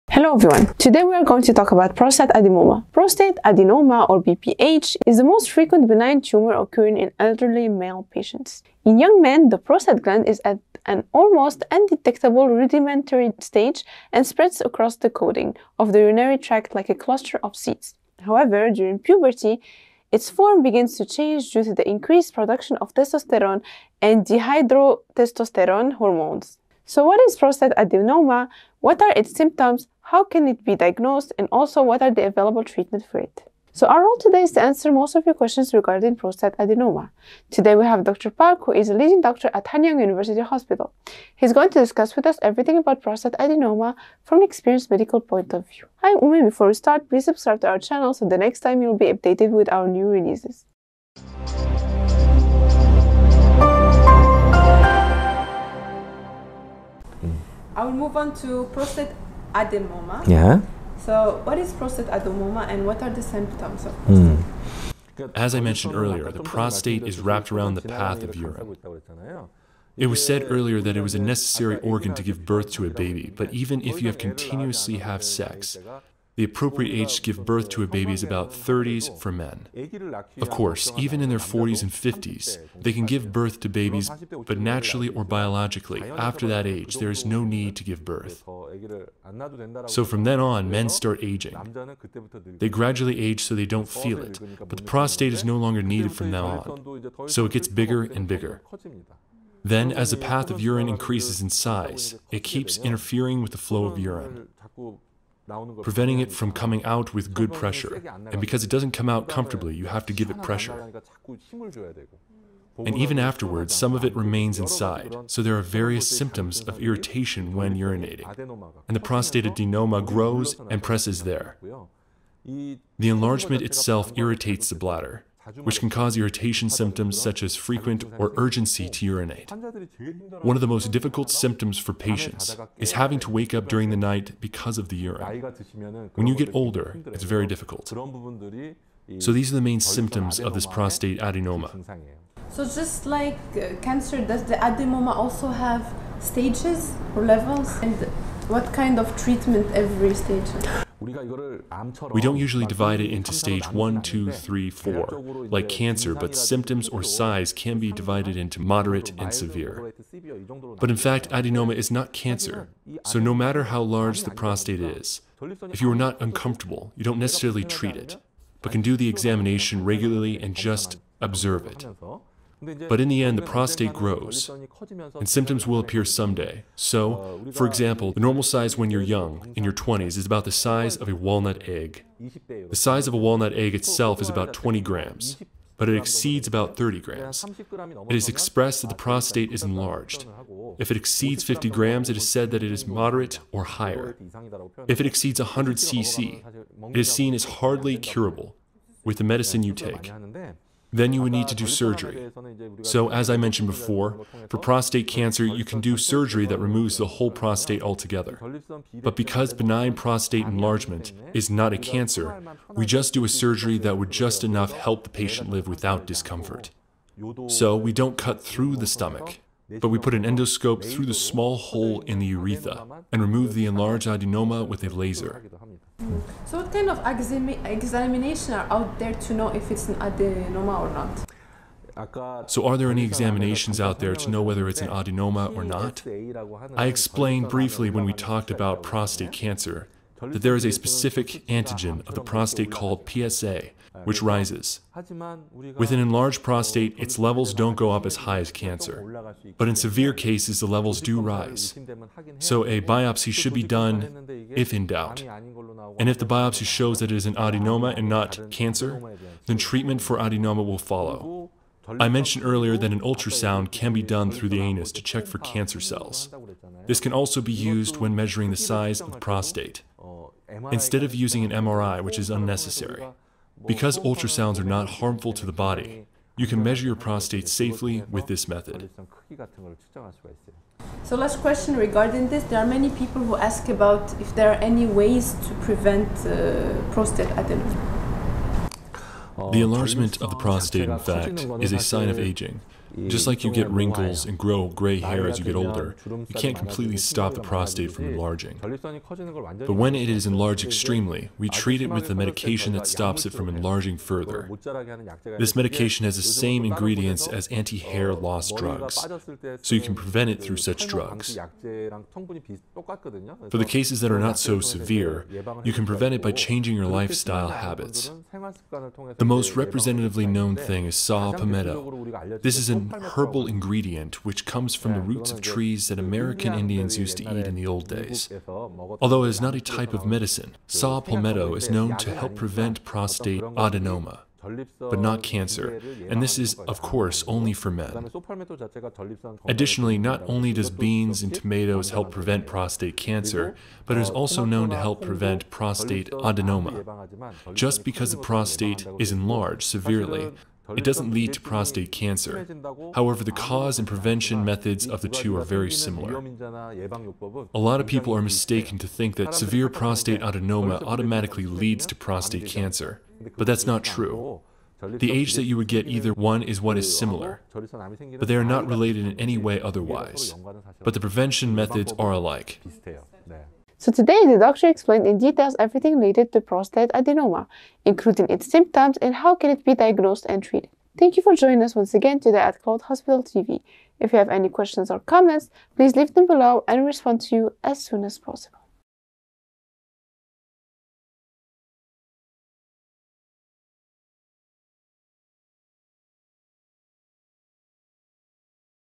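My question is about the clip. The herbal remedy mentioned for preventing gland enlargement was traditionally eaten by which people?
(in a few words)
American Indians.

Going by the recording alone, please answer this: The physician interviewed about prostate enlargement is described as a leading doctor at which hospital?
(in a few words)
Hanyang University Hospital.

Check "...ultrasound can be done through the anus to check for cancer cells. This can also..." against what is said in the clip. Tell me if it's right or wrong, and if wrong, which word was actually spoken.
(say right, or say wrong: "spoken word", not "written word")
right.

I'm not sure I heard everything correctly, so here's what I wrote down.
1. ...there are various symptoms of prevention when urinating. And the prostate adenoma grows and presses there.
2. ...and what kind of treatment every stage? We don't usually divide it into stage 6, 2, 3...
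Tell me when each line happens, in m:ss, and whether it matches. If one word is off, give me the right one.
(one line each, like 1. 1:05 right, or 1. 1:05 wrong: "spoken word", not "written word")
1. 1:55 wrong: "irritation", not "prevention"
2. 2:27 wrong: "1", not "6".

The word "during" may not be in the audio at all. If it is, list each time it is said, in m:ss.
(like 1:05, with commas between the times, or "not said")
0:18, 2:13.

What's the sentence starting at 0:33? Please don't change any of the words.
So our role today is to answer most of your questions regarding prostate adenoma.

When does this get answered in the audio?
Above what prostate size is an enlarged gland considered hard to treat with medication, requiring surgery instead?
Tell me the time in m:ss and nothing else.
3:15.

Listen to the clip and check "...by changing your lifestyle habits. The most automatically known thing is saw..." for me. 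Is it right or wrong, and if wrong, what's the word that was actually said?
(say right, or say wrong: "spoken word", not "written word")
wrong: "representatively", not "automatically".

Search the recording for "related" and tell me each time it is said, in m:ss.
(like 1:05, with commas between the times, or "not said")
6:08, 6:15.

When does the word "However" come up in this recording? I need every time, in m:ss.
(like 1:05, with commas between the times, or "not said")
0:18, 5:52.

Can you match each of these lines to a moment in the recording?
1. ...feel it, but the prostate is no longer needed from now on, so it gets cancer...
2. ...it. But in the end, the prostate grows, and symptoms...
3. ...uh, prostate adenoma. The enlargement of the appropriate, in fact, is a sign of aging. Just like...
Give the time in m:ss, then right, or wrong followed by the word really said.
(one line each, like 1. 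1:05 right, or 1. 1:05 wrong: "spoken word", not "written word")
1. 1:33 wrong: "bigger", not "cancer"
2. 2:51 right
3. 4:46 wrong: "prostate", not "appropriate".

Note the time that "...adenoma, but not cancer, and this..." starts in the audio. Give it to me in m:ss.
5:33.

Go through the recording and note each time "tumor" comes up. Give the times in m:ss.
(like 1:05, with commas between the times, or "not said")
0:06.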